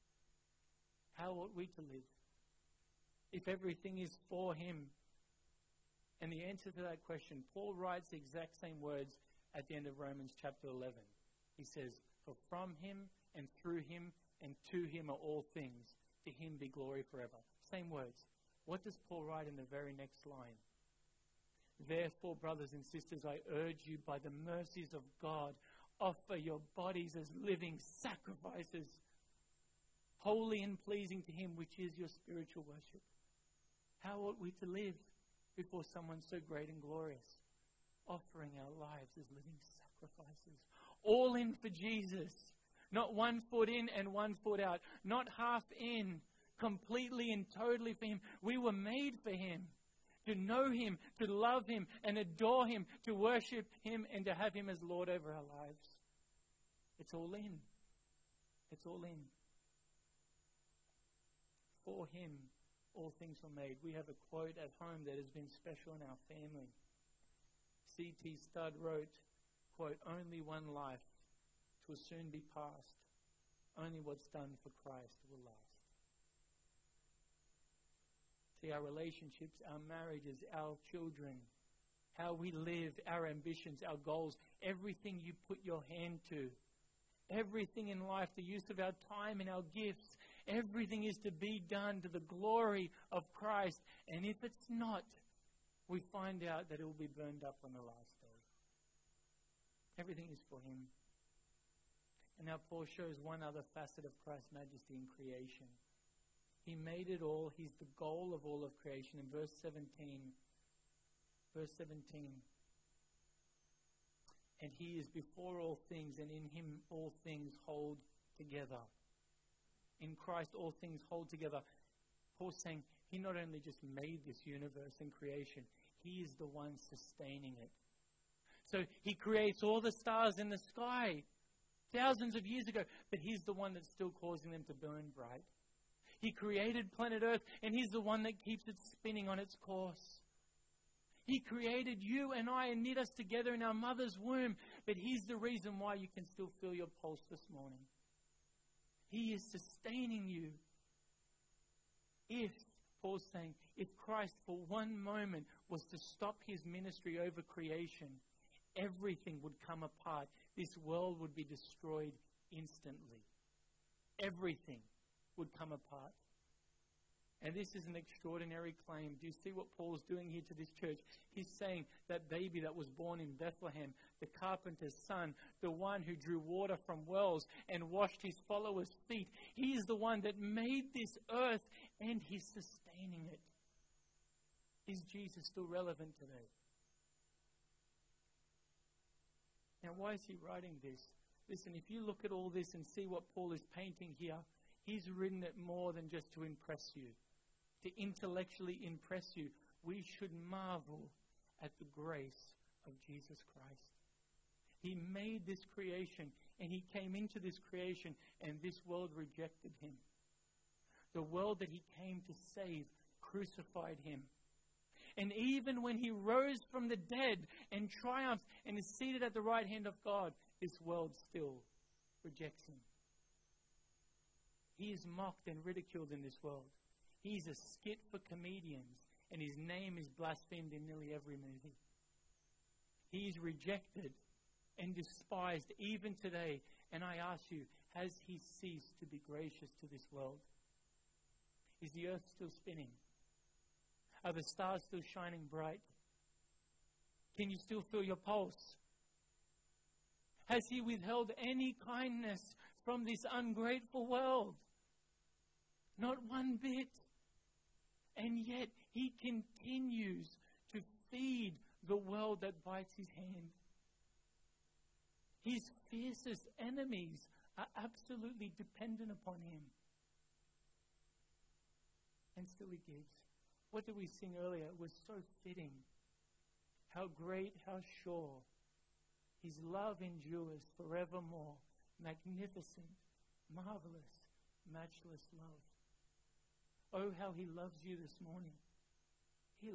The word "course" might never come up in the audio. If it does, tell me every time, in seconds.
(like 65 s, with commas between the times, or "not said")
139 s.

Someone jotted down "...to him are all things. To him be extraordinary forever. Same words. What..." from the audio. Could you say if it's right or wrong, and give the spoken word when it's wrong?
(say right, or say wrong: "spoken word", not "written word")
wrong: "glory", not "extraordinary".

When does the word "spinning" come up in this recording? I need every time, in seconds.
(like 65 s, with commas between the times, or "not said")
138 s, 242 s.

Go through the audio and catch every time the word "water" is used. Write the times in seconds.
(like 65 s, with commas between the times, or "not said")
176 s.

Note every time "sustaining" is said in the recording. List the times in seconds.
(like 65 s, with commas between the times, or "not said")
126 s, 149 s, 182 s.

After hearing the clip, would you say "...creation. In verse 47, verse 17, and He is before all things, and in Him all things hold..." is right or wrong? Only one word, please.
wrong.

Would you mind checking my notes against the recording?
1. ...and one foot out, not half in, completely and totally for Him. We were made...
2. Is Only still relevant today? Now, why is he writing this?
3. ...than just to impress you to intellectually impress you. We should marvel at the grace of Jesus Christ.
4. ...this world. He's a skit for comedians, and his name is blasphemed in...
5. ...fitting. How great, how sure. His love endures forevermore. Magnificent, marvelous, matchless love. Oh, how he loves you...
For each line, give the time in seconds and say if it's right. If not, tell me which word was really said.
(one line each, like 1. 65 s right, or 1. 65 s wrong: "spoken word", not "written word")
1. 43 s right
2. 184 s wrong: "Jesus", not "Only"
3. 195 s right
4. 226 s right
5. 275 s right.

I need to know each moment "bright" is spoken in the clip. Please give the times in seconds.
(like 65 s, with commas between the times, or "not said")
135 s, 245 s.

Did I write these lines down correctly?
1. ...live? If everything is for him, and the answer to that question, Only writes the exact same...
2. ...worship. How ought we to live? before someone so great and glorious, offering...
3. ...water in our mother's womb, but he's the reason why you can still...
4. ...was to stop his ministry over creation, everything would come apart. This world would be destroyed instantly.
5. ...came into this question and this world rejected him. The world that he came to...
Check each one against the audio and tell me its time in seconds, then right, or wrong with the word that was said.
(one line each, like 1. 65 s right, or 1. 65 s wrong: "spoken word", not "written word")
1. 1 s wrong: "Paul", not "Only"
2. 32 s right
3. 143 s wrong: "together", not "water"
4. 155 s right
5. 206 s wrong: "creation", not "question".